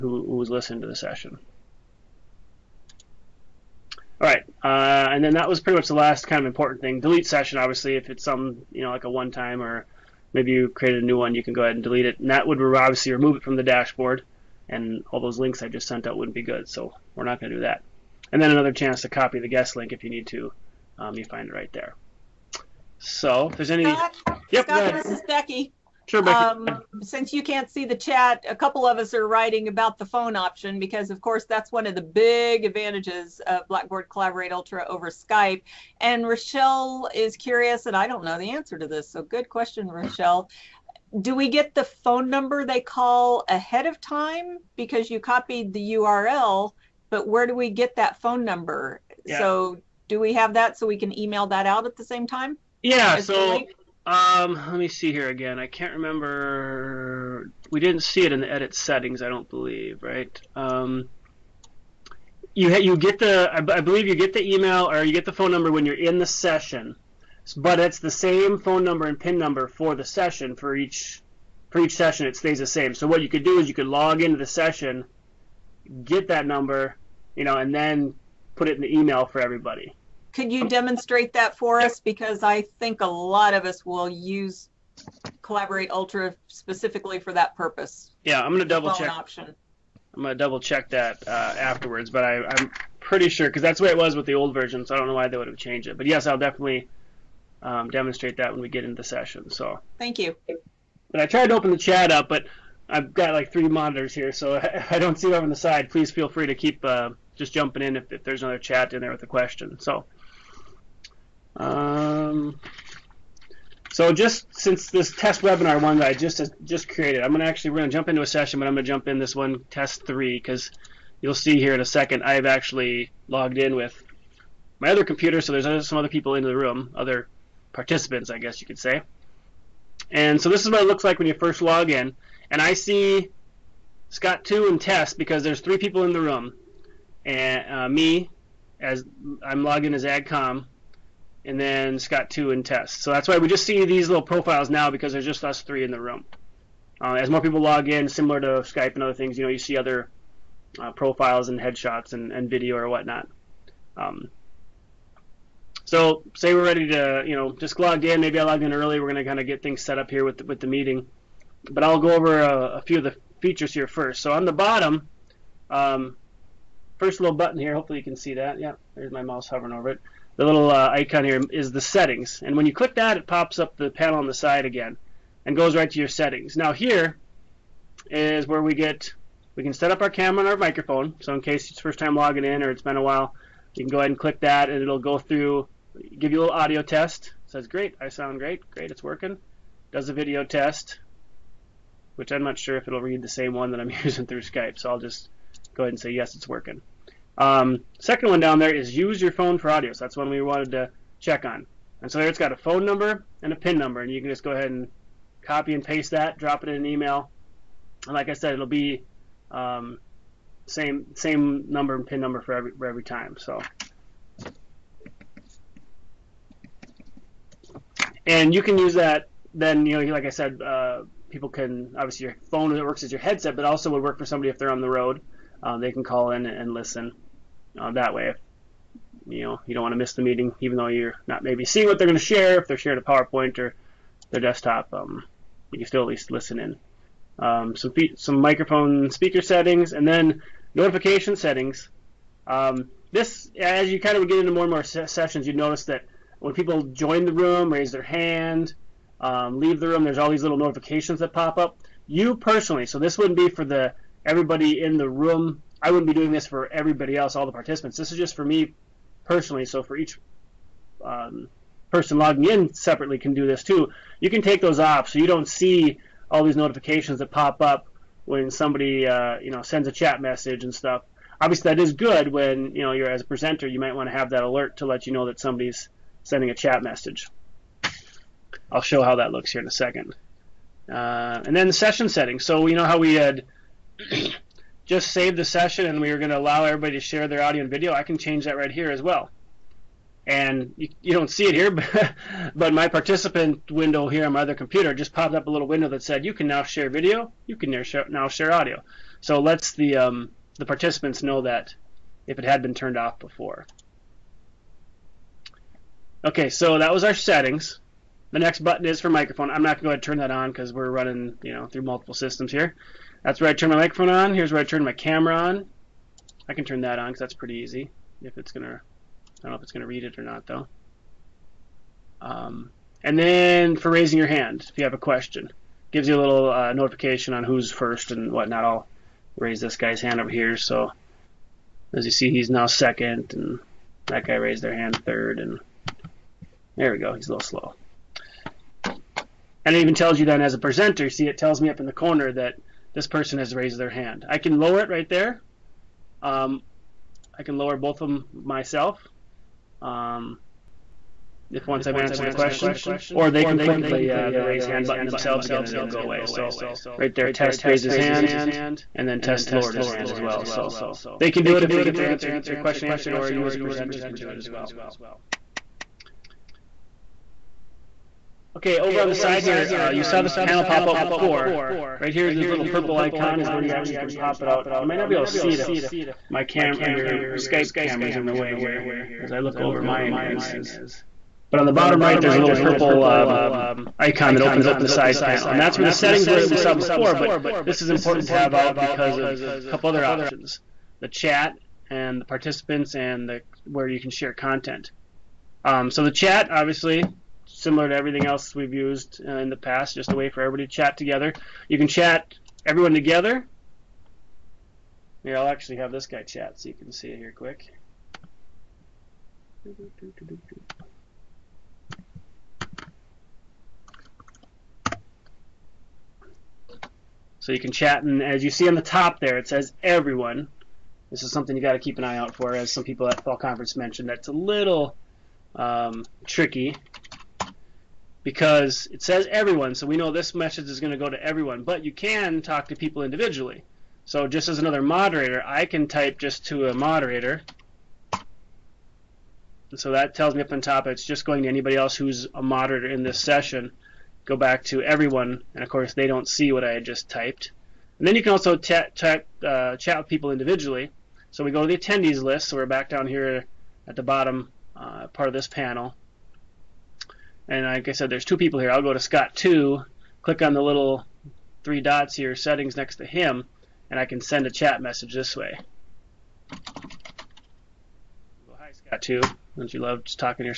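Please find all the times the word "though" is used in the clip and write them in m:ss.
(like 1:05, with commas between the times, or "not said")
3:50, 5:20.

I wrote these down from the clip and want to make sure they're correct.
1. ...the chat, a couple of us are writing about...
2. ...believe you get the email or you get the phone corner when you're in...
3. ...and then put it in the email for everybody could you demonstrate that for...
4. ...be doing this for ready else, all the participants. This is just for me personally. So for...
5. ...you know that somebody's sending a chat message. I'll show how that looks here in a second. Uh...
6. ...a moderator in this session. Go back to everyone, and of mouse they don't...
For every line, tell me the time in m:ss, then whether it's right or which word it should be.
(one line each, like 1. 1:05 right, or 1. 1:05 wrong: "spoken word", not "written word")
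1. 0:27 right
2. 1:03 wrong: "number", not "corner"
3. 1:17 right
4. 4:16 wrong: "everybody", not "ready"
5. 4:35 right
6. 7:22 wrong: "course", not "mouse".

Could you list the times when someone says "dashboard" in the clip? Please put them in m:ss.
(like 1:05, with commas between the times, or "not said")
0:13.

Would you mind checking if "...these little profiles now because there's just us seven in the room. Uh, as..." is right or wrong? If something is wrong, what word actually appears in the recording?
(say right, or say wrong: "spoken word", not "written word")
wrong: "three", not "seven".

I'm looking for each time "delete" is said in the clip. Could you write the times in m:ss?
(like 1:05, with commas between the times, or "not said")
0:06, 0:11.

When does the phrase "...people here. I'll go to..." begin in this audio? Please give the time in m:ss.
7:38.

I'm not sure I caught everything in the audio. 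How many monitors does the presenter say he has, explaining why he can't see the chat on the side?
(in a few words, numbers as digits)
3.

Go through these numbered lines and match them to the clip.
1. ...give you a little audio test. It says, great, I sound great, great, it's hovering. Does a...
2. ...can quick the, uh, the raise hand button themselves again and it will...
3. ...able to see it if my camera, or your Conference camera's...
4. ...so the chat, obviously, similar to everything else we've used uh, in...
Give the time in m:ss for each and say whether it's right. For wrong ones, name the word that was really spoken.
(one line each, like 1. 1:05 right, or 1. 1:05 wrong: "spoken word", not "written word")
1. 3:06 wrong: "working", not "hovering"
2. 5:53 wrong: "click", not "quick"
3. 6:15 wrong: "Skype", not "Conference"
4. 6:35 right.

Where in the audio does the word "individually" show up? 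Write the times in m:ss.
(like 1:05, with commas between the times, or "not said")
7:13, 7:30.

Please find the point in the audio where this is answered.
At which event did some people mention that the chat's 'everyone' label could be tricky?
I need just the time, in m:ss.
7:03.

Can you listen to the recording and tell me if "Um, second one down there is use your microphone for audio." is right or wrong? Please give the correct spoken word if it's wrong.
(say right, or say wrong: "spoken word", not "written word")
wrong: "phone", not "microphone".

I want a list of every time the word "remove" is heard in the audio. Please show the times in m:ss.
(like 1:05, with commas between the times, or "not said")
0:13.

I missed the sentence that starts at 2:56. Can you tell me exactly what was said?
Now here is where we get, we can set up our camera and our microphone.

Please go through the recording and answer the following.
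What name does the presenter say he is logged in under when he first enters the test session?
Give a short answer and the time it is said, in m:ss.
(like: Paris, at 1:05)
AgCom, at 2:20.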